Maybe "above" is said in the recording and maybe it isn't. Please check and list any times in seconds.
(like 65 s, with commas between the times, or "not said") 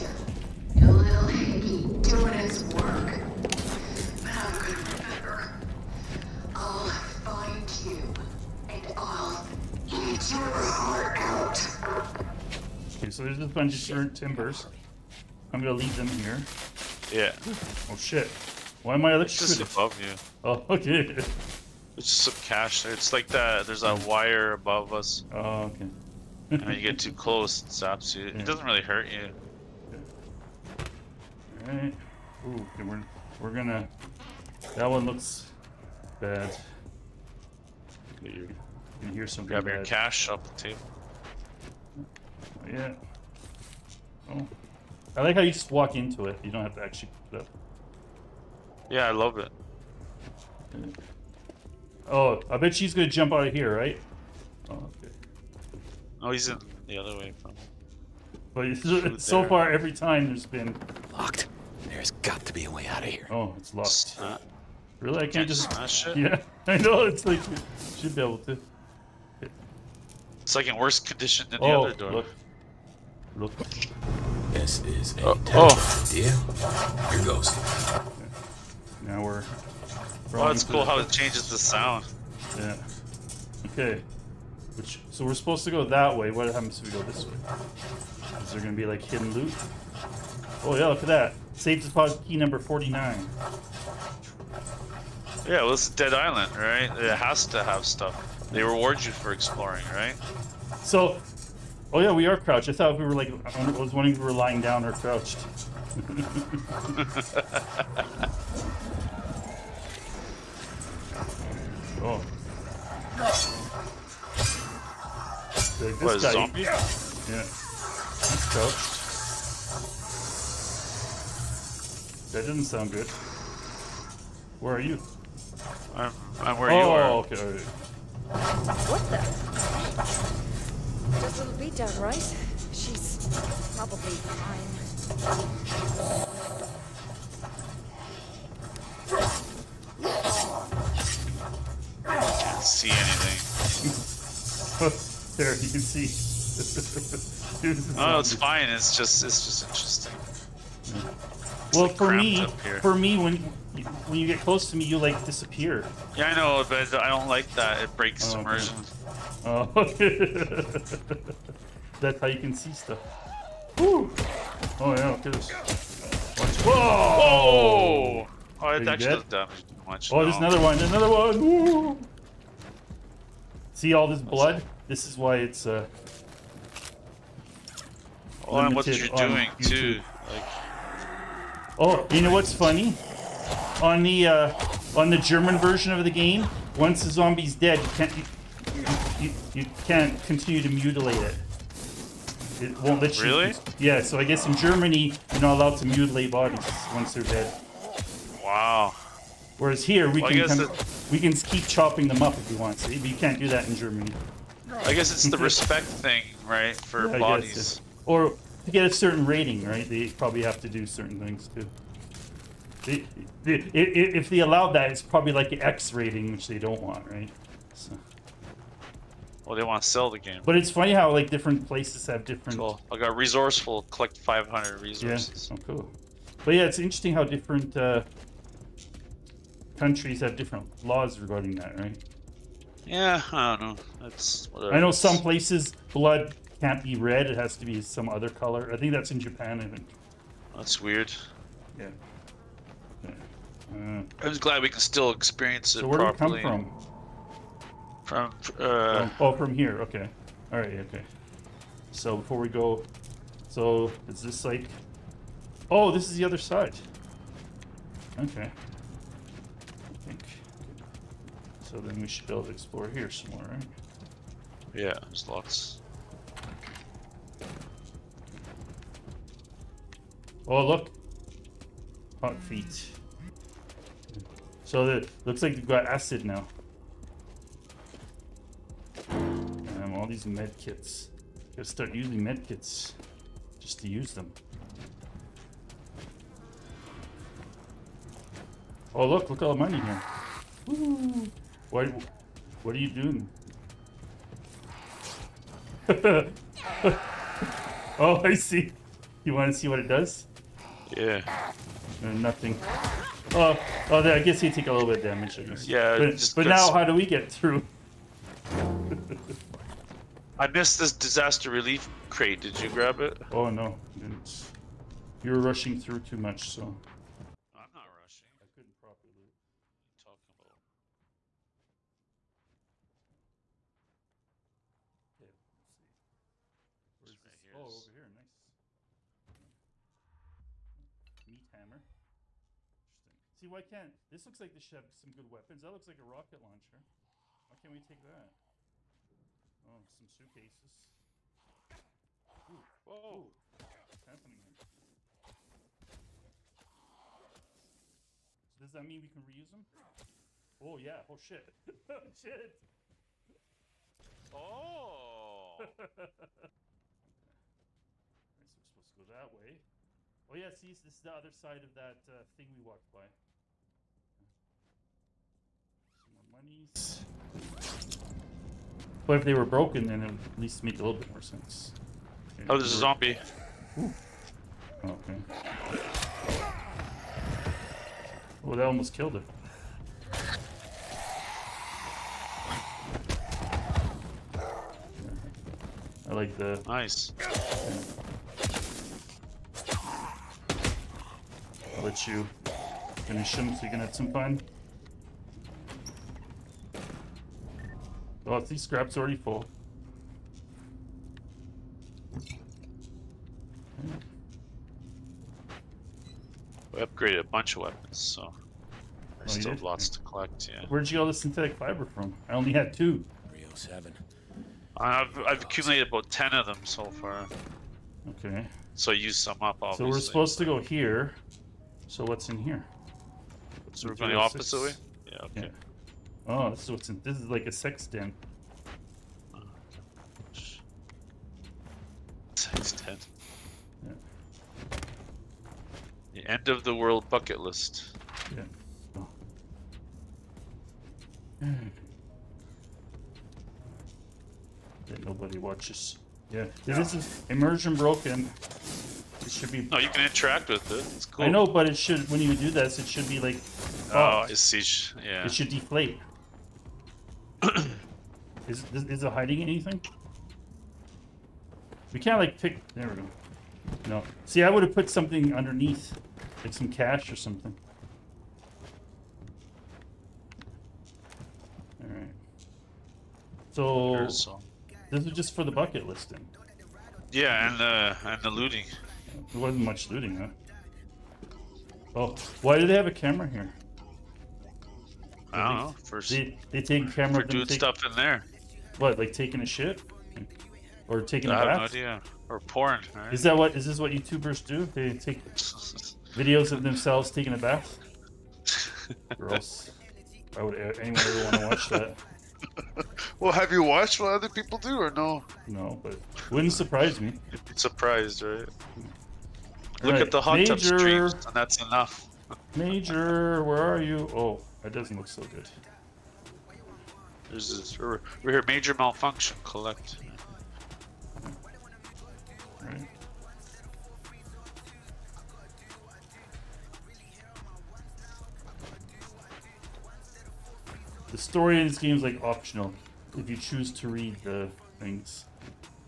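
19 s, 24 s.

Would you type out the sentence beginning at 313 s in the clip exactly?
Oh no, You are rushing through too much, so.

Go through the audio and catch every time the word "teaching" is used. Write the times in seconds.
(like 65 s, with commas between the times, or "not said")
not said.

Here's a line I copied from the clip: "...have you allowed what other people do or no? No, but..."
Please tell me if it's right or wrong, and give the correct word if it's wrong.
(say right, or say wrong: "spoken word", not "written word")
wrong: "watched", not "allowed".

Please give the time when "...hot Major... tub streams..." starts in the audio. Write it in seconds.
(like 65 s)
510 s.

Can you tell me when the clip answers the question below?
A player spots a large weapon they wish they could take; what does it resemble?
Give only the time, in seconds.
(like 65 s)
336 s.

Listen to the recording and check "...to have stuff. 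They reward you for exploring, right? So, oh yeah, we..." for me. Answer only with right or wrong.
right.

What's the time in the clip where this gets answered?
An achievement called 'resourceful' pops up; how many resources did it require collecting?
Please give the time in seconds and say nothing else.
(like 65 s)
224 s.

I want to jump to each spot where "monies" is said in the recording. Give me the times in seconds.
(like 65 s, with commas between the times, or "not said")
366 s.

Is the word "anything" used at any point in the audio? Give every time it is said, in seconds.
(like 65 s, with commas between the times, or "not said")
142 s, 459 s.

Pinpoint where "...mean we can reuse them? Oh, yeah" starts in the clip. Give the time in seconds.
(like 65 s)
348 s.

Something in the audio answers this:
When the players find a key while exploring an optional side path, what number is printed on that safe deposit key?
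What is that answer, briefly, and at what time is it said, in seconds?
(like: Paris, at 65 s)
49, at 92 s.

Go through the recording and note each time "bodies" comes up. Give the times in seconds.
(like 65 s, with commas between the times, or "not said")
196 s, 207 s.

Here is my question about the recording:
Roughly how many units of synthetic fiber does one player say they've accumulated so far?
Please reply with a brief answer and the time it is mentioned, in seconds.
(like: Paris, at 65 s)
10, at 416 s.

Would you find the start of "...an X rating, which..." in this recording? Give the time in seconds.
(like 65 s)
215 s.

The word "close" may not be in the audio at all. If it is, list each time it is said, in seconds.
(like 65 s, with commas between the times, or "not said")
27 s, 154 s.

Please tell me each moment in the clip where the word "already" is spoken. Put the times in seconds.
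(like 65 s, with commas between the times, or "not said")
398 s.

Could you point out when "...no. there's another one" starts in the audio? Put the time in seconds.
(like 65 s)
170 s.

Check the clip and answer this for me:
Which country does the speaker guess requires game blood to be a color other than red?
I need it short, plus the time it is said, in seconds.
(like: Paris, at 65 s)
Japan, at 239 s.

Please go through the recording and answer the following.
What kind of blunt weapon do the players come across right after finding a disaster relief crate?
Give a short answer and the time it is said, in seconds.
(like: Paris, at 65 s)
Meat hammer, at 331 s.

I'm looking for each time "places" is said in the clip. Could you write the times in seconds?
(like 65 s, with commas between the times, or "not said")
221 s, 235 s.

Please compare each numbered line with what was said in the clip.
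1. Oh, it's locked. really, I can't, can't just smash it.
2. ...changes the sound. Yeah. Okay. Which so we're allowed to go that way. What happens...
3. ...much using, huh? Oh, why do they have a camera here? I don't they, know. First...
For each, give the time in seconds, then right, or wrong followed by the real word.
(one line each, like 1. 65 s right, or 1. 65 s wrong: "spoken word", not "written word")
1. 63 s right
2. 81 s wrong: "supposed", not "allowed"
3. 479 s wrong: "looting", not "using".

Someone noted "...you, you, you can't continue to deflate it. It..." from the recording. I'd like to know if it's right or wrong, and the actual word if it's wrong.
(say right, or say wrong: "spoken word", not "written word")
wrong: "mutilate", not "deflate".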